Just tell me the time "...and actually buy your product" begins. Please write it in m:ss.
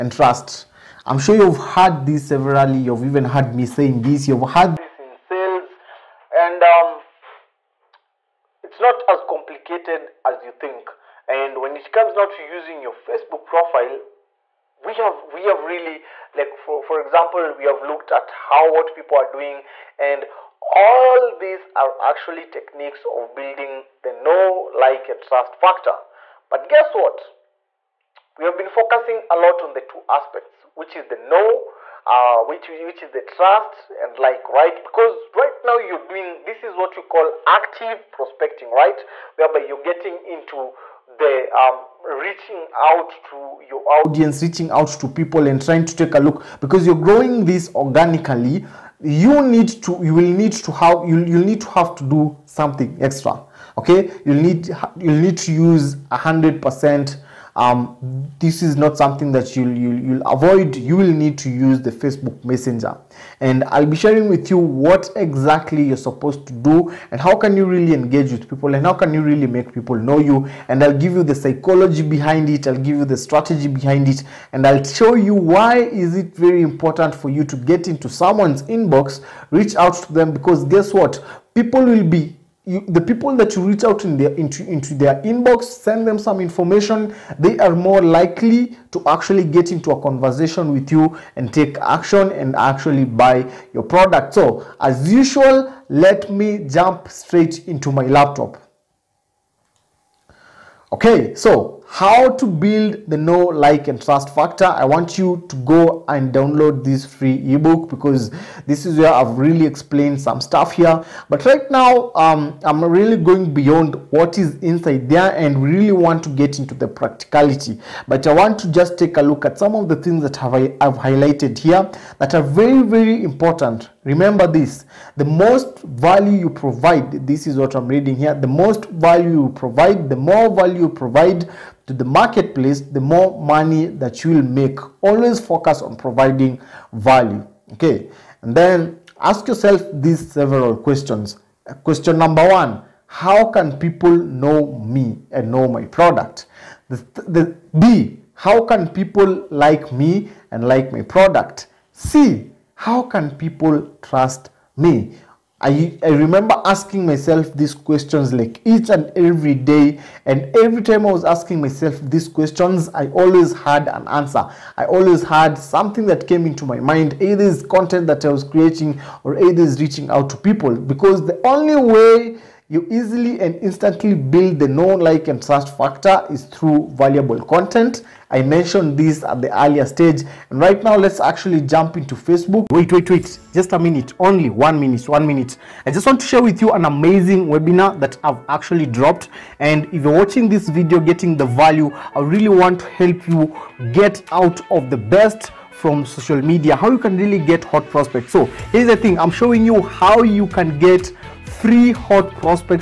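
1:32.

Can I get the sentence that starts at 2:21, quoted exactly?
Question number one, how can people know me and know my product?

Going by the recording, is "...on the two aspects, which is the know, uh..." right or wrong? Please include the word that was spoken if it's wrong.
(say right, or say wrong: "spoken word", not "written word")
right.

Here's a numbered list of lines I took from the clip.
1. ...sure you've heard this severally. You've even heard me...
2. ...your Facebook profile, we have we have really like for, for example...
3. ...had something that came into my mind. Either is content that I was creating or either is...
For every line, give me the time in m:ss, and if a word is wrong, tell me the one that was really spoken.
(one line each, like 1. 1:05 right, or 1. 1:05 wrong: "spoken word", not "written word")
1. 0:01 right
2. 0:12 right
3. 2:45 right.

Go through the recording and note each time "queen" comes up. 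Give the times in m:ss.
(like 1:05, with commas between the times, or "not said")
not said.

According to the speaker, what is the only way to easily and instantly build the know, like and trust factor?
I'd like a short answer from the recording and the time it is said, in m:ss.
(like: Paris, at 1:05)
Valuable content, at 2:56.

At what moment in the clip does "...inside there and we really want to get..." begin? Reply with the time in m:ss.
1:54.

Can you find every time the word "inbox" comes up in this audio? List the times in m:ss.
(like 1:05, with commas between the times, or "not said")
1:18, 1:25.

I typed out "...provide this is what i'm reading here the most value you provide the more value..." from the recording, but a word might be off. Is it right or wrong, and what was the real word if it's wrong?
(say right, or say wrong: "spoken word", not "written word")
right.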